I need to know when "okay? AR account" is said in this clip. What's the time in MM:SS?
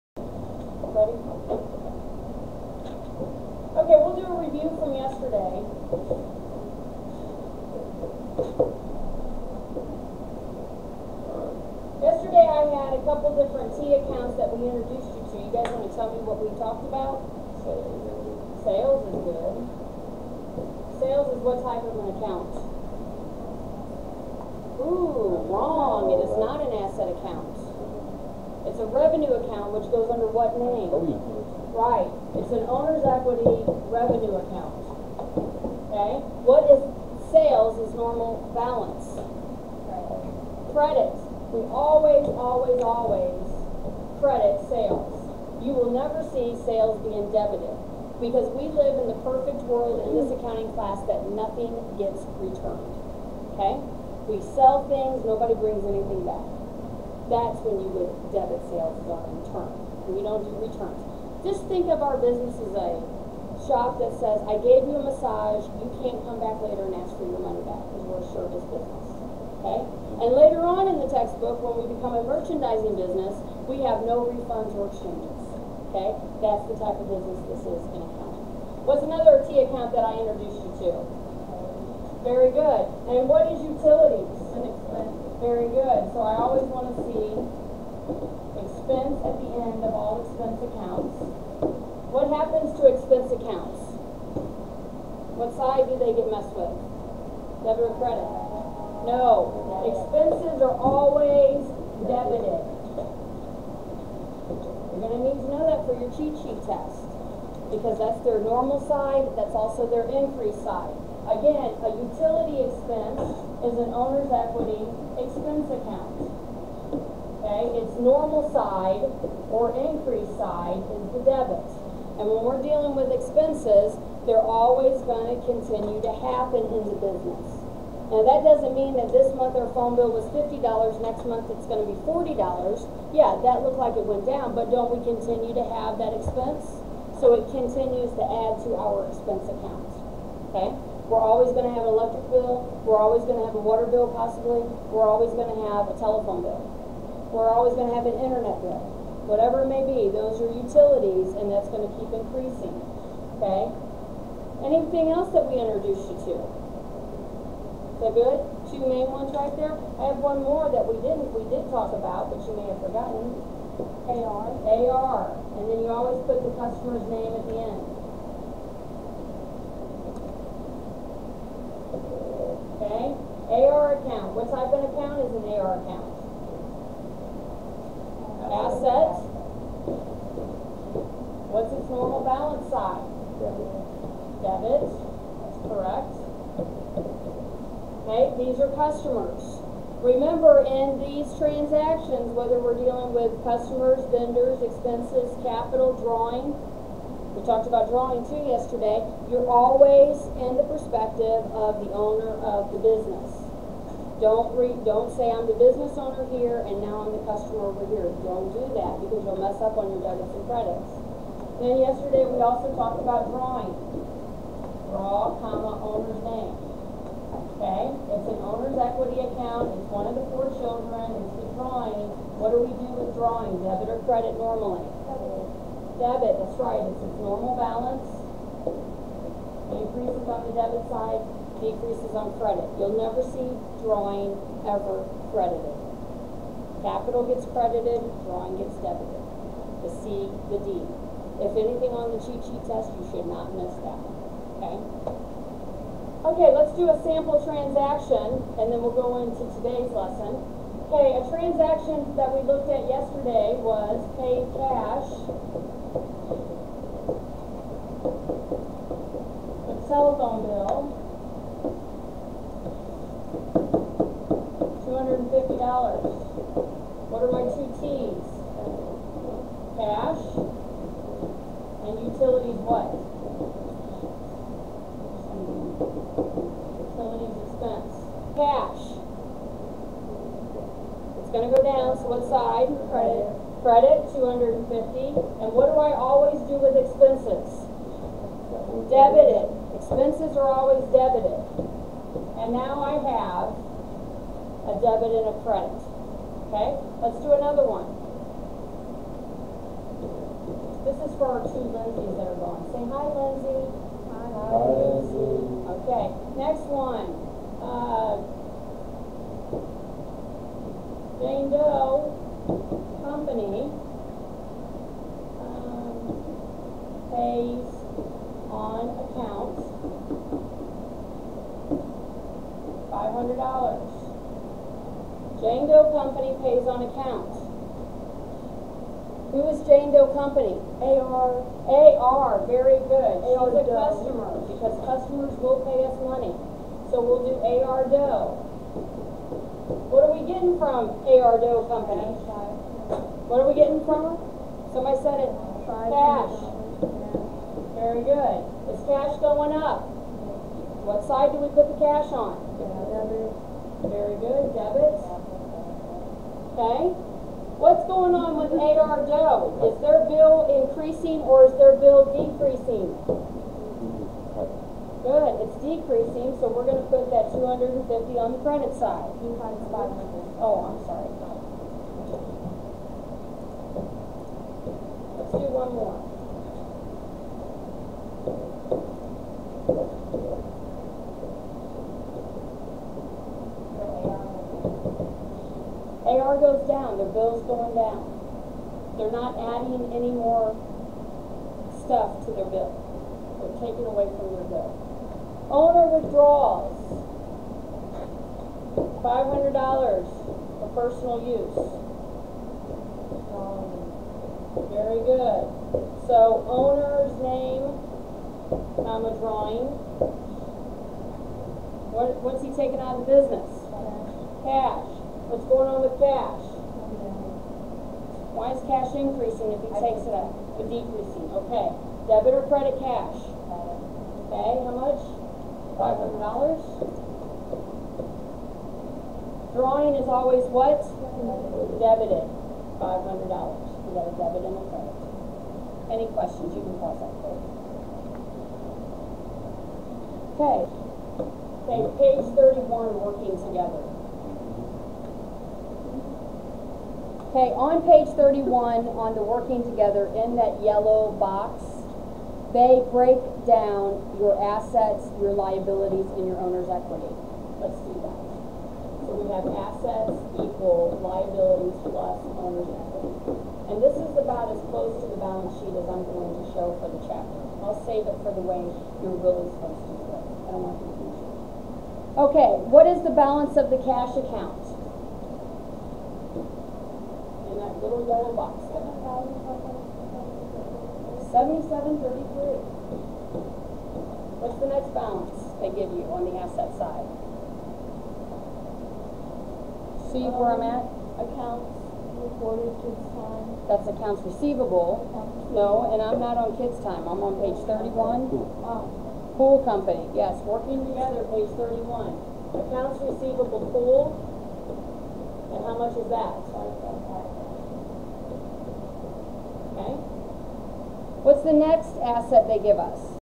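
02:52.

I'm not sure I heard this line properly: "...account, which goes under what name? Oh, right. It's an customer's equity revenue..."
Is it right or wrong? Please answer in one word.
wrong.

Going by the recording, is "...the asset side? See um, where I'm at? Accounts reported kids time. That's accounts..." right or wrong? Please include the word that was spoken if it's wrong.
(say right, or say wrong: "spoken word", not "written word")
right.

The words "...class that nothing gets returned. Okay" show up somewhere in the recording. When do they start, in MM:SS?
00:50.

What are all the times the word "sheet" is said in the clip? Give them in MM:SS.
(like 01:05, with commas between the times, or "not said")
01:46, 04:02, 07:45.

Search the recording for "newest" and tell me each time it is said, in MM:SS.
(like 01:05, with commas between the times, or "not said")
not said.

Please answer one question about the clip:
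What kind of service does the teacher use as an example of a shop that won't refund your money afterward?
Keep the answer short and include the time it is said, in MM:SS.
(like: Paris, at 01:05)
massage, at 01:05.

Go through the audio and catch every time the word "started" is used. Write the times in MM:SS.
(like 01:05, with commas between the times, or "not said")
not said.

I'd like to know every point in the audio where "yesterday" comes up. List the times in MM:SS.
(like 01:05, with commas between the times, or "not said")
00:04, 00:12, 03:18, 03:31, 04:12.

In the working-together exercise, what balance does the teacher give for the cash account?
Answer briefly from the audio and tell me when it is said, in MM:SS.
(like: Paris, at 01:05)
7733, at 07:58.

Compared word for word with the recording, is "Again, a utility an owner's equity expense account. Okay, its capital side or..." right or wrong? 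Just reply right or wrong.
wrong.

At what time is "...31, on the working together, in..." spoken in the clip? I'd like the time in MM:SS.
07:28.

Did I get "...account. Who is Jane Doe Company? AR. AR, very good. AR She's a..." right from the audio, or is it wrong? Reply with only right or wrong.
right.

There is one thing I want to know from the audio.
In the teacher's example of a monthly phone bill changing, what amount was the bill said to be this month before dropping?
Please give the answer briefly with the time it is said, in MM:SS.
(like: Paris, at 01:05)
$50, at 02:10.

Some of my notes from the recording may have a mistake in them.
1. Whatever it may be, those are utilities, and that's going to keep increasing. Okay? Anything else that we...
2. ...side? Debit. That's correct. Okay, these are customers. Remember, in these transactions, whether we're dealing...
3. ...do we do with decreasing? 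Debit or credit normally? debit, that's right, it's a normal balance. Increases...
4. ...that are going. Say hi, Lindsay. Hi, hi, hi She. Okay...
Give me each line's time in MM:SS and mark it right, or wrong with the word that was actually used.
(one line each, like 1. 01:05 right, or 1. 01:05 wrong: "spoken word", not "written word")
1. 02:29 right
2. 03:02 right
3. 03:42 wrong: "drawing", not "decreasing"
4. 05:02 wrong: "Lindsay", not "She".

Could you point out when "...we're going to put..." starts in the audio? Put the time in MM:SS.
06:06.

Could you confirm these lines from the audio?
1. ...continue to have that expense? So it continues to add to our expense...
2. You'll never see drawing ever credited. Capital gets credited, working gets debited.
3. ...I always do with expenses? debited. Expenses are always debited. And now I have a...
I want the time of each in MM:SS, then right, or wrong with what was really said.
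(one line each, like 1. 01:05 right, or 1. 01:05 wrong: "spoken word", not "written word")
1. 02:15 right
2. 03:52 wrong: "drawing", not "working"
3. 04:45 right.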